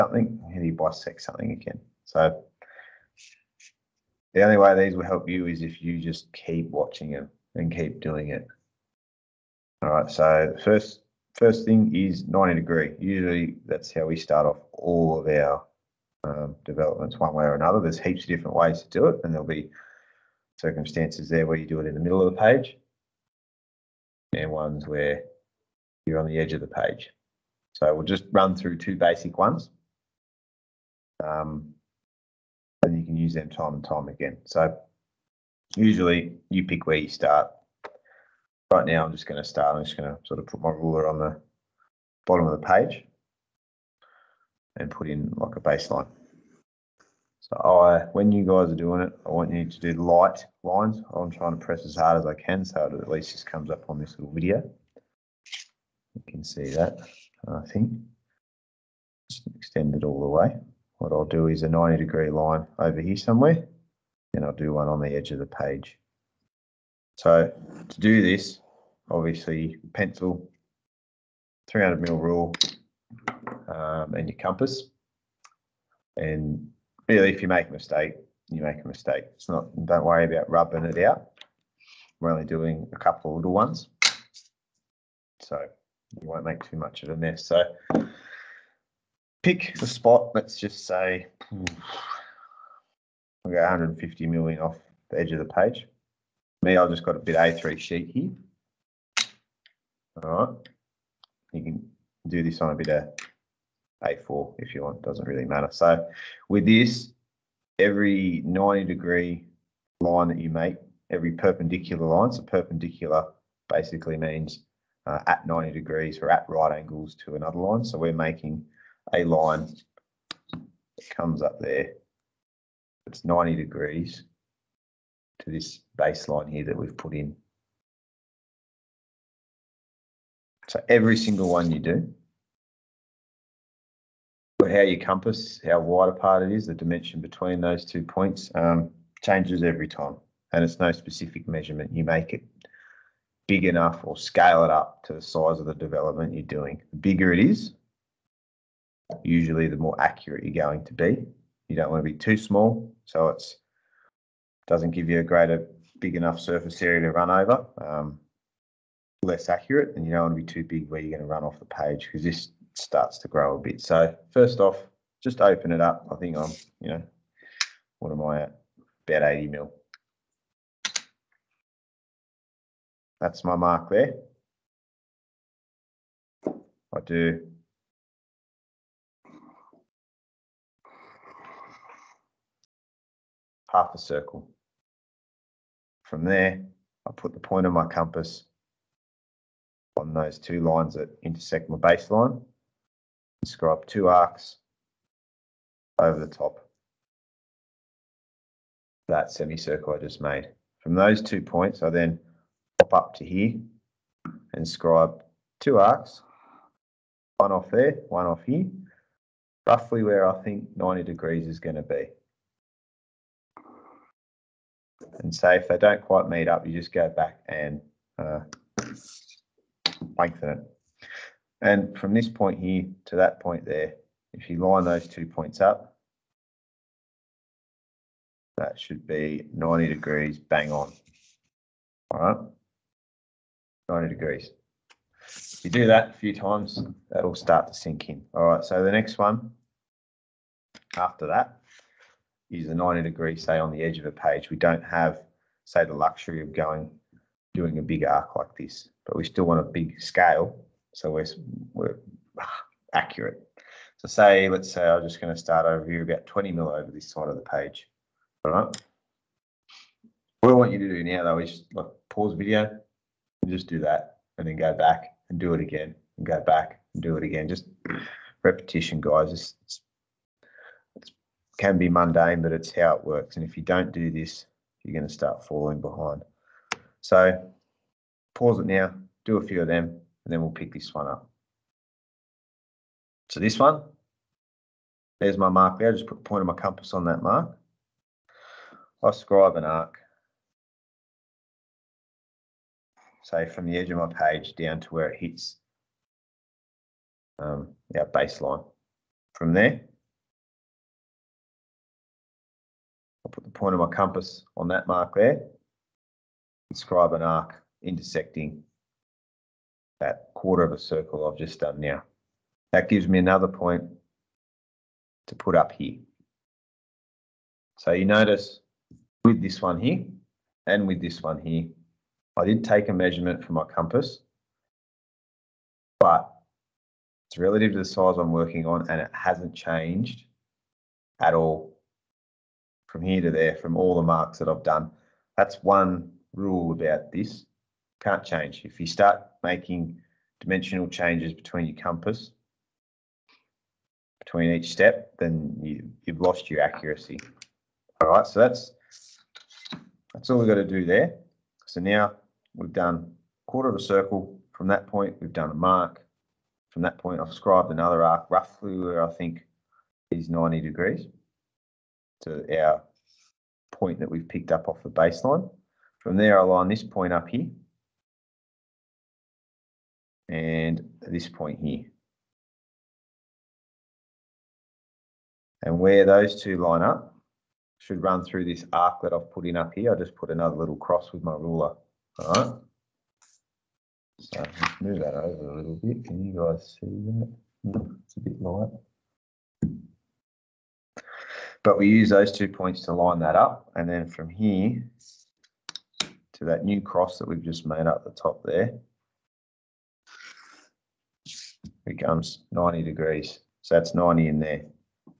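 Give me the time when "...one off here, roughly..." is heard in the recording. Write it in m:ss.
3:28.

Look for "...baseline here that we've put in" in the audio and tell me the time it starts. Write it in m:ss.
2:05.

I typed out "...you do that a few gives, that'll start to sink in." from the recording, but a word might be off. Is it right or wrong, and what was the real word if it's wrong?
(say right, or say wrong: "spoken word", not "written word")
wrong: "times", not "gives".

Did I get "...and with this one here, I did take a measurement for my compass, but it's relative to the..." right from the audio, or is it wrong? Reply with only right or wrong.
right.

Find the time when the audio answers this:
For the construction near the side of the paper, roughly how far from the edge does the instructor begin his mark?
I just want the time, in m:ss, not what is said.
4:16.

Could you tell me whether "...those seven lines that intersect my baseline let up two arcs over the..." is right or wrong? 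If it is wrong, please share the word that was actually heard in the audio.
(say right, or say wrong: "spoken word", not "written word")
wrong: "two", not "seven".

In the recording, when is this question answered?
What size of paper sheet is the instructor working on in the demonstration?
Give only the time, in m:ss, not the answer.
1:37.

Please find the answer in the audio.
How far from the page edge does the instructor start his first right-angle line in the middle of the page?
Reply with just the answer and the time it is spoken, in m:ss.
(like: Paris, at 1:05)
150 mm, at 1:33.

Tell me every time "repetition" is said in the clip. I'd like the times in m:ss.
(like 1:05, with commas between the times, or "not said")
4:28.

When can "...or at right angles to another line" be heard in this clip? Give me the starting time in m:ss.
1:56.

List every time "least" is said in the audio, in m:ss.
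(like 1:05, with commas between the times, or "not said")
0:53.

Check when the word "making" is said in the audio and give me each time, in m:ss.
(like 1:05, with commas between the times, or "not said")
1:58, 5:39.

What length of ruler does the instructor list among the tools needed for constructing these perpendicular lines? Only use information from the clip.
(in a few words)
300 mm.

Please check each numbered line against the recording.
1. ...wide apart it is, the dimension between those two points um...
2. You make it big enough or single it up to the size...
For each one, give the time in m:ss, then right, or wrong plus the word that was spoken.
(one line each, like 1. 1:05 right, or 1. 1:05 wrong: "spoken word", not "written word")
1. 2:15 right
2. 2:21 wrong: "scale", not "single".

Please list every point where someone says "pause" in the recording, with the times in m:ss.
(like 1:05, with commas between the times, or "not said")
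4:22, 4:38.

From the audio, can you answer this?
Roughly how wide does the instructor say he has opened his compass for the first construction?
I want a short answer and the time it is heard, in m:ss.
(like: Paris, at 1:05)
About 80 mm, at 2:49.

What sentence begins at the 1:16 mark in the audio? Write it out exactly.
And really, if you make a mistake, you make a mistake.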